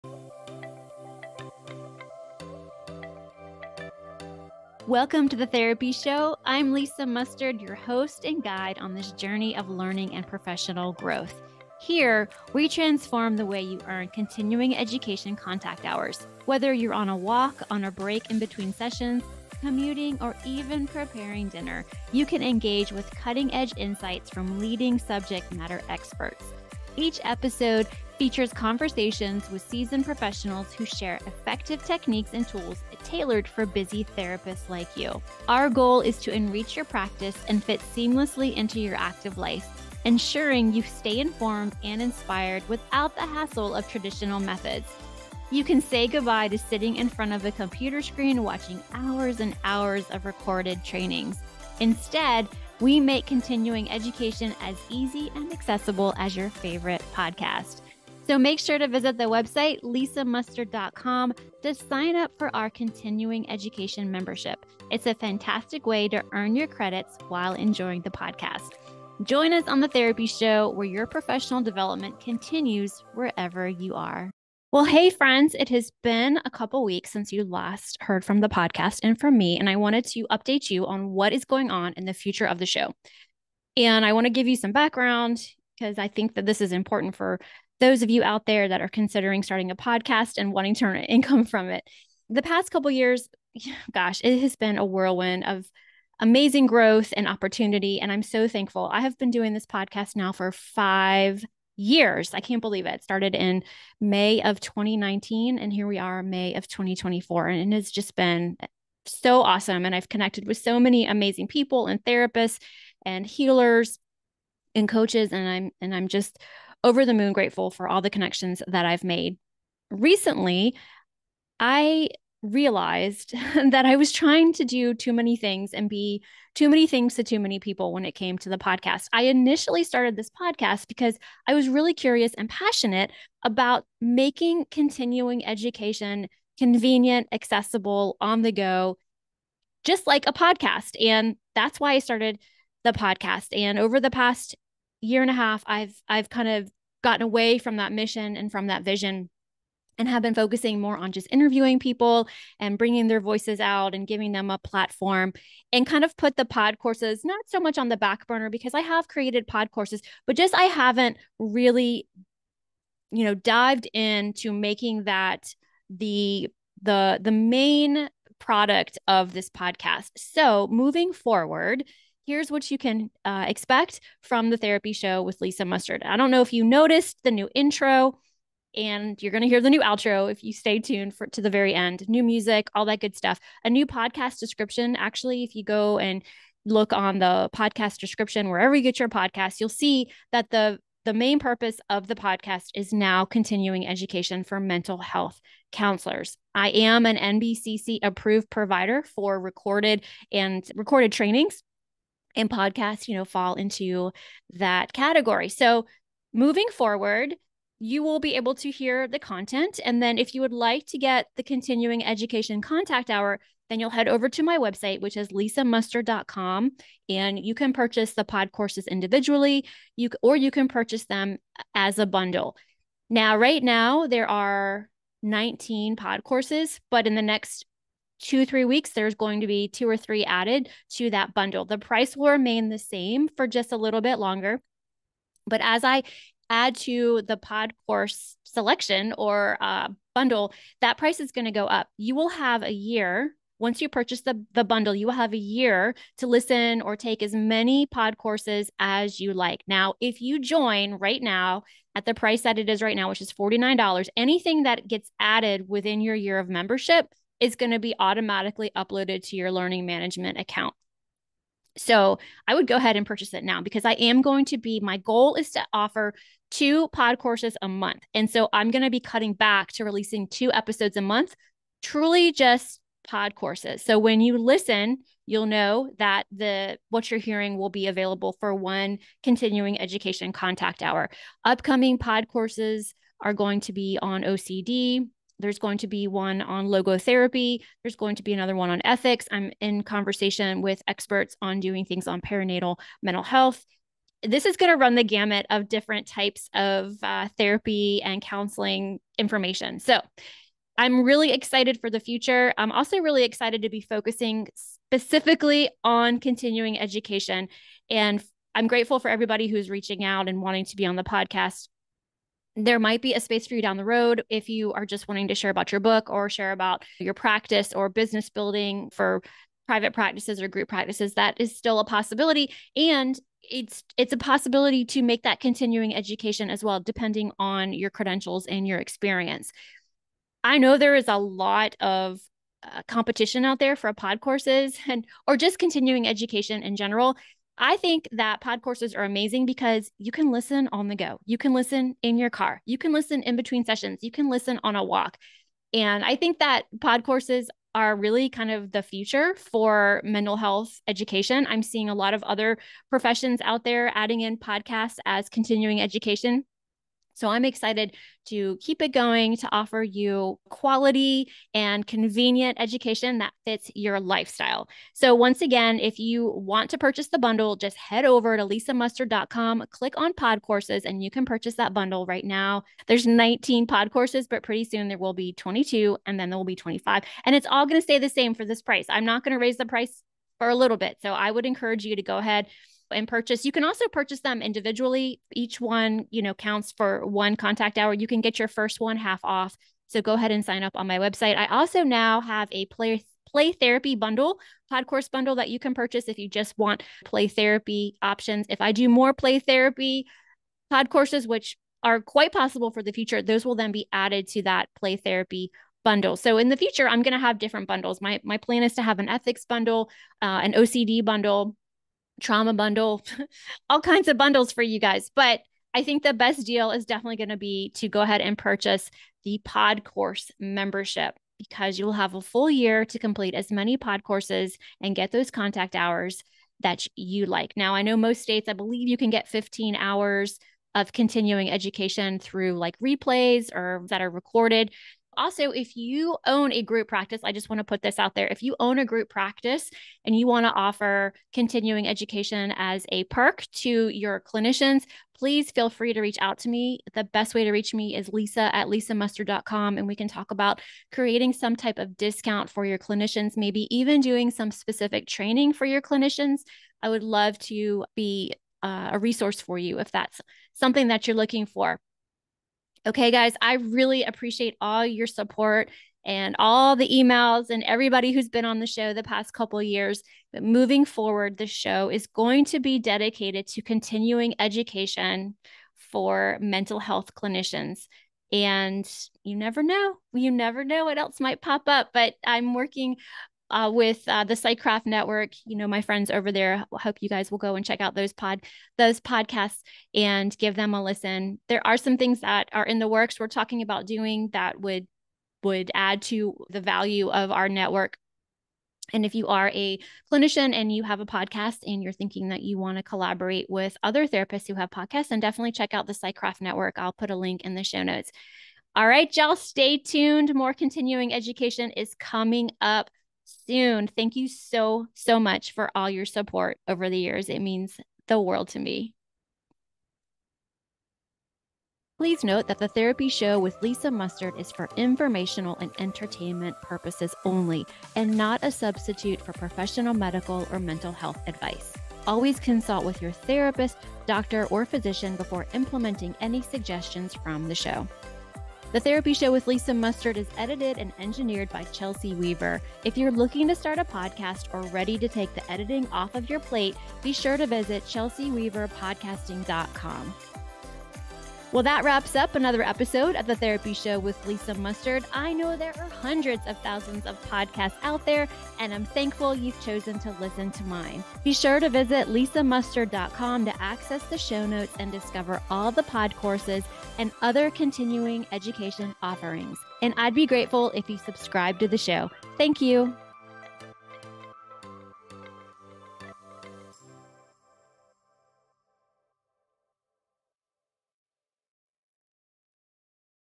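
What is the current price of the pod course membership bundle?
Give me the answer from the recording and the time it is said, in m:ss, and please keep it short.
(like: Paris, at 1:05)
$49, at 4:13.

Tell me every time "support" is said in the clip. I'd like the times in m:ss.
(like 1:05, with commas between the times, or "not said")
7:45, 8:36.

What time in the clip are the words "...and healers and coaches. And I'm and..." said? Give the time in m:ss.
1:53.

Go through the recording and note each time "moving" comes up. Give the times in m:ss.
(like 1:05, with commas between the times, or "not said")
2:50, 3:26, 7:50.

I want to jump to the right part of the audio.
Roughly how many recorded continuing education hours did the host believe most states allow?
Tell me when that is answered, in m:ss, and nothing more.
7:09.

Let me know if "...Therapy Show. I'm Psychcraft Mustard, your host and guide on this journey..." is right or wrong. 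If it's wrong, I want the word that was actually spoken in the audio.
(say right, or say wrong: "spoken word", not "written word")
wrong: "Lisa", not "Psychcraft".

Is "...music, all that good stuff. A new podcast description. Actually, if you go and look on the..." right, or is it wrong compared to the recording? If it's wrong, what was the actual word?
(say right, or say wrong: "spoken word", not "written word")
right.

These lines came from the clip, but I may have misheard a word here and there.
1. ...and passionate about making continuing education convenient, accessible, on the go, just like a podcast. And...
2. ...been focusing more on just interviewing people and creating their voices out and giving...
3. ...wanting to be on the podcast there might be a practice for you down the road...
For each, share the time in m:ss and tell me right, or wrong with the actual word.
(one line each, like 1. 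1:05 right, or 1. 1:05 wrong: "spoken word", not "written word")
1. 2:12 right
2. 2:30 wrong: "bringing", not "creating"
3. 5:10 wrong: "space", not "practice".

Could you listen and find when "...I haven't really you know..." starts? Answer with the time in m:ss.
2:40.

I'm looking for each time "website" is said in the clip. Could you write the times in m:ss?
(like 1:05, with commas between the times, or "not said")
0:59, 3:34, 6:30.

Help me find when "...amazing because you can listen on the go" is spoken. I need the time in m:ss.
5:39.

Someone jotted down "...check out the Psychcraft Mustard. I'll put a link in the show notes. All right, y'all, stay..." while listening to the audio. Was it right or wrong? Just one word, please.
wrong.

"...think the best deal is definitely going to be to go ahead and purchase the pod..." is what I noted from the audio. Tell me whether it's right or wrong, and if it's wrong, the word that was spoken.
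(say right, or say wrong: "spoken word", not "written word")
right.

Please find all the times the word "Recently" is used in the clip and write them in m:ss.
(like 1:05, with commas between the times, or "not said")
1:59.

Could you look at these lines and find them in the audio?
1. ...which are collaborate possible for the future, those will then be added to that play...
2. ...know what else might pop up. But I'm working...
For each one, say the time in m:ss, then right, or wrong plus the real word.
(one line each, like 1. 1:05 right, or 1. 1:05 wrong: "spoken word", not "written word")
1. 6:41 wrong: "quite", not "collaborate"
2. 8:00 right.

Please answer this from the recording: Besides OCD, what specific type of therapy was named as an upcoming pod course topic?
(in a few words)
logotherapy.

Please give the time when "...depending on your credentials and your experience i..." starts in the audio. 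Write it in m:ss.
5:26.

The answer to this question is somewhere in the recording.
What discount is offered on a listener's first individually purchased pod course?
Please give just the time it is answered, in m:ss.
6:28.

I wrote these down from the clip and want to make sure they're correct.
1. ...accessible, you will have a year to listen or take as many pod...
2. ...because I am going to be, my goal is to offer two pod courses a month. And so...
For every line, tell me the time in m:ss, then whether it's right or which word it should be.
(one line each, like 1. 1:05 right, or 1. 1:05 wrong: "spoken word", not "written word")
1. 4:04 wrong: "bundle", not "accessible"
2. 4:23 right.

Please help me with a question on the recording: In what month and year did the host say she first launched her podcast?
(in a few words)
May 2019.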